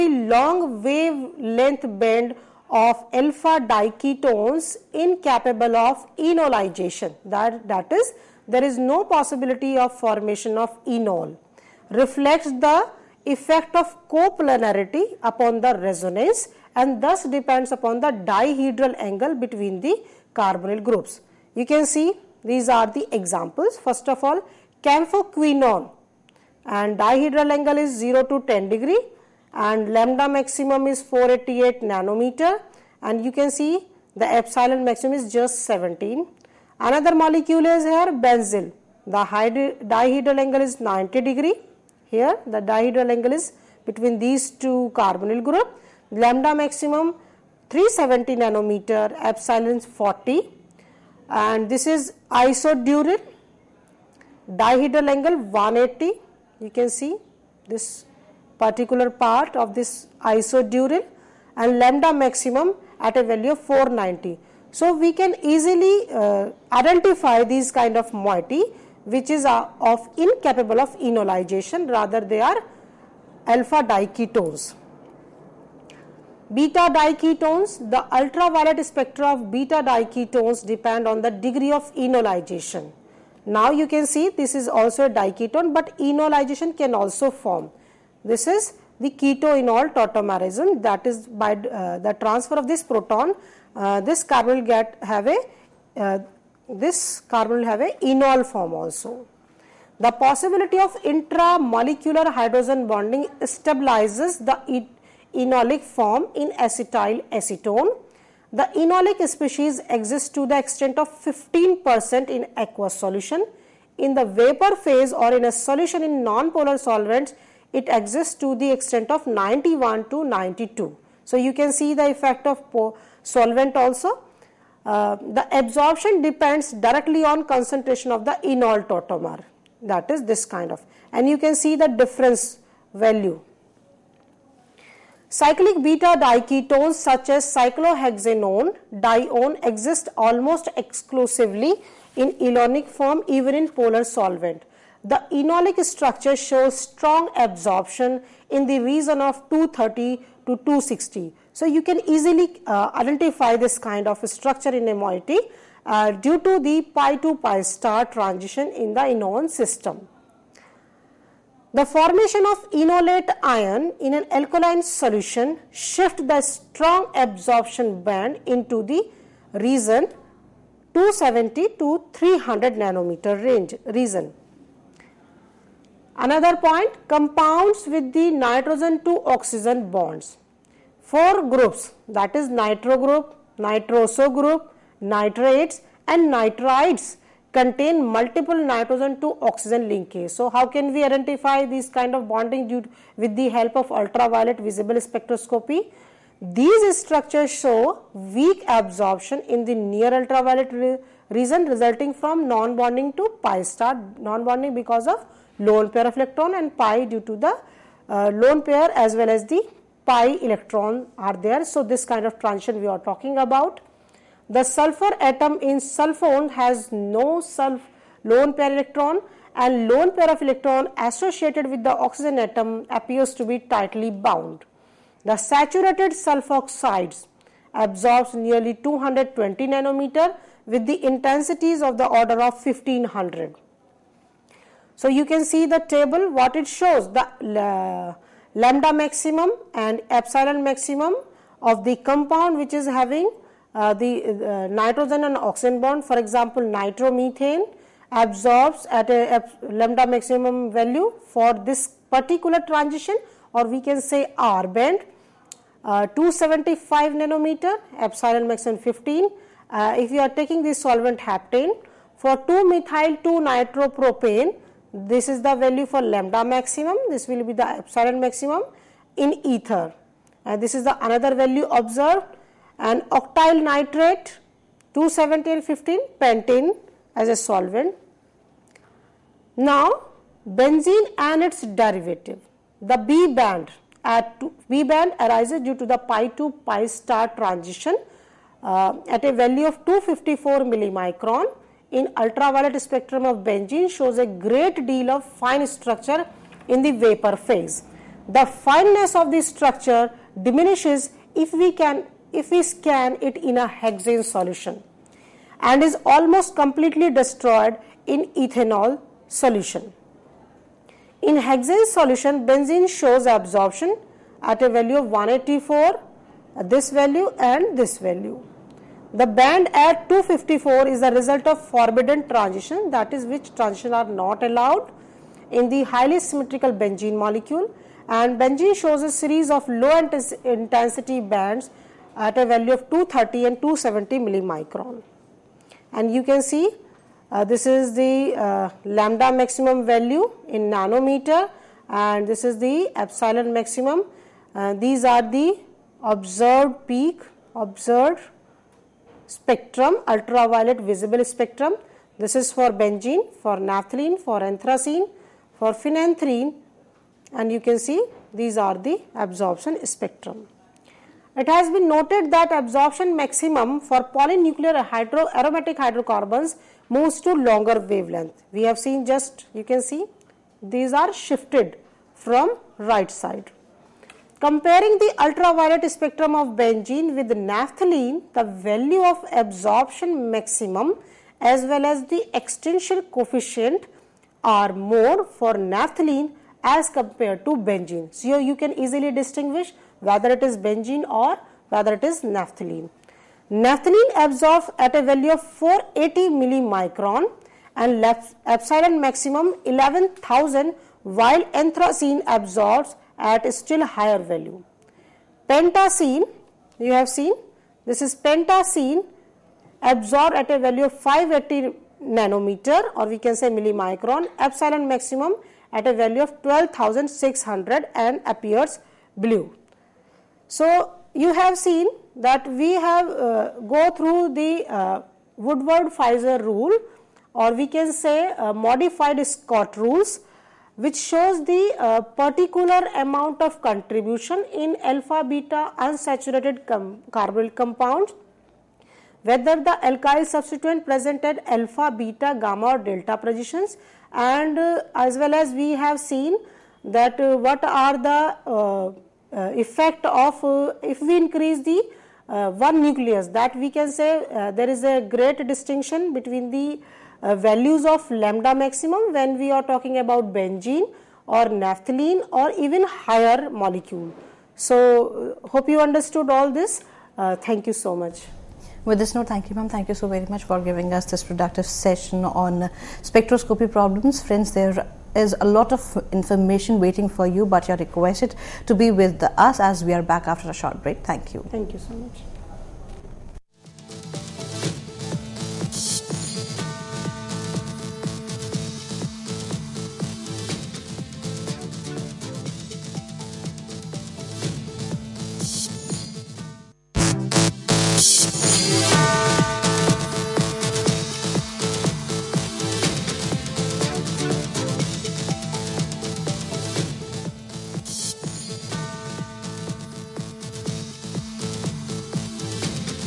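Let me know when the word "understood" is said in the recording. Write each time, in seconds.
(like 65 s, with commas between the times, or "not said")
465 s.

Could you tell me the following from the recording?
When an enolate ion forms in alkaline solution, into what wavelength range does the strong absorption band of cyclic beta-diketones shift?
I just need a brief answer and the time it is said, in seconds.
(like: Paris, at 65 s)
270 to 300 nm, at 170 s.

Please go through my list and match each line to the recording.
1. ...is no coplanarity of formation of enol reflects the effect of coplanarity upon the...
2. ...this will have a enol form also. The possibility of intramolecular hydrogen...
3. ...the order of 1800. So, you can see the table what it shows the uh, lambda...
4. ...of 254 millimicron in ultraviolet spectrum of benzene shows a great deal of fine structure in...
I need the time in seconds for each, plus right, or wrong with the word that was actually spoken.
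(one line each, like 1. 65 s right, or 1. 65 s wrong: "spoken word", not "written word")
1. 8 s wrong: "possibility", not "coplanarity"
2. 96 s right
3. 231 s wrong: "1500", not "1800"
4. 289 s right.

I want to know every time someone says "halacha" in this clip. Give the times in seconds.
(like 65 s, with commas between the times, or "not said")
not said.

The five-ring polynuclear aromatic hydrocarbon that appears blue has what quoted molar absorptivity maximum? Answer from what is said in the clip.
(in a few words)
12,600.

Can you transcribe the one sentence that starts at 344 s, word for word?
Uh, these are the observed peak, observed spectrum, ultraviolet visible spectrum.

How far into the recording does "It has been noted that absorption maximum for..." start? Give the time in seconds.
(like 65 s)
361 s.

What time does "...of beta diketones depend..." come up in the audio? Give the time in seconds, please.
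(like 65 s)
79 s.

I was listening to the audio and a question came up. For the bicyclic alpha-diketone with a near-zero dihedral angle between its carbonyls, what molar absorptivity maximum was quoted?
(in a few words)
17.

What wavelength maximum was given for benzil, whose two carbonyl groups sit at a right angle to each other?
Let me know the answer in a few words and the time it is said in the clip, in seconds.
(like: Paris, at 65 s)
370 nanometer, at 47 s.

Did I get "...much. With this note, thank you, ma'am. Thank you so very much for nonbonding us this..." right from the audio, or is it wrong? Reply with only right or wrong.
wrong.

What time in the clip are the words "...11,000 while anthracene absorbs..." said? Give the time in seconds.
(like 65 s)
399 s.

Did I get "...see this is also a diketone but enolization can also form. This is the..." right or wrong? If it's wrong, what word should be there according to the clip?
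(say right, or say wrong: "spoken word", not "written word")
right.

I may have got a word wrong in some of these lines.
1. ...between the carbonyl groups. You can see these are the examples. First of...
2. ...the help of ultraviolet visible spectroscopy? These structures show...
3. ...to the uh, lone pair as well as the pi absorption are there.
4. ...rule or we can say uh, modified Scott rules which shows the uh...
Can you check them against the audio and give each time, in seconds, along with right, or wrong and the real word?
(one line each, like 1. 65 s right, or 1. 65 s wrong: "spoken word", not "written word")
1. 19 s right
2. 193 s right
3. 207 s wrong: "electron", not "absorption"
4. 426 s right.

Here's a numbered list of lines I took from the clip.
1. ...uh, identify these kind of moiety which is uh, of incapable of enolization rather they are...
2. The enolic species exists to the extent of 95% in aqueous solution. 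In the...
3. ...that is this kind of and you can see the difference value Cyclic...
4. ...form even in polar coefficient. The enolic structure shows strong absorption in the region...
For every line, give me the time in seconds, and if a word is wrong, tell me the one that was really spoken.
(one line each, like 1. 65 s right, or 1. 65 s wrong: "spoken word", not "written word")
1. 66 s right
2. 108 s wrong: "15", not "95"
3. 129 s right
4. 142 s wrong: "solvent", not "coefficient".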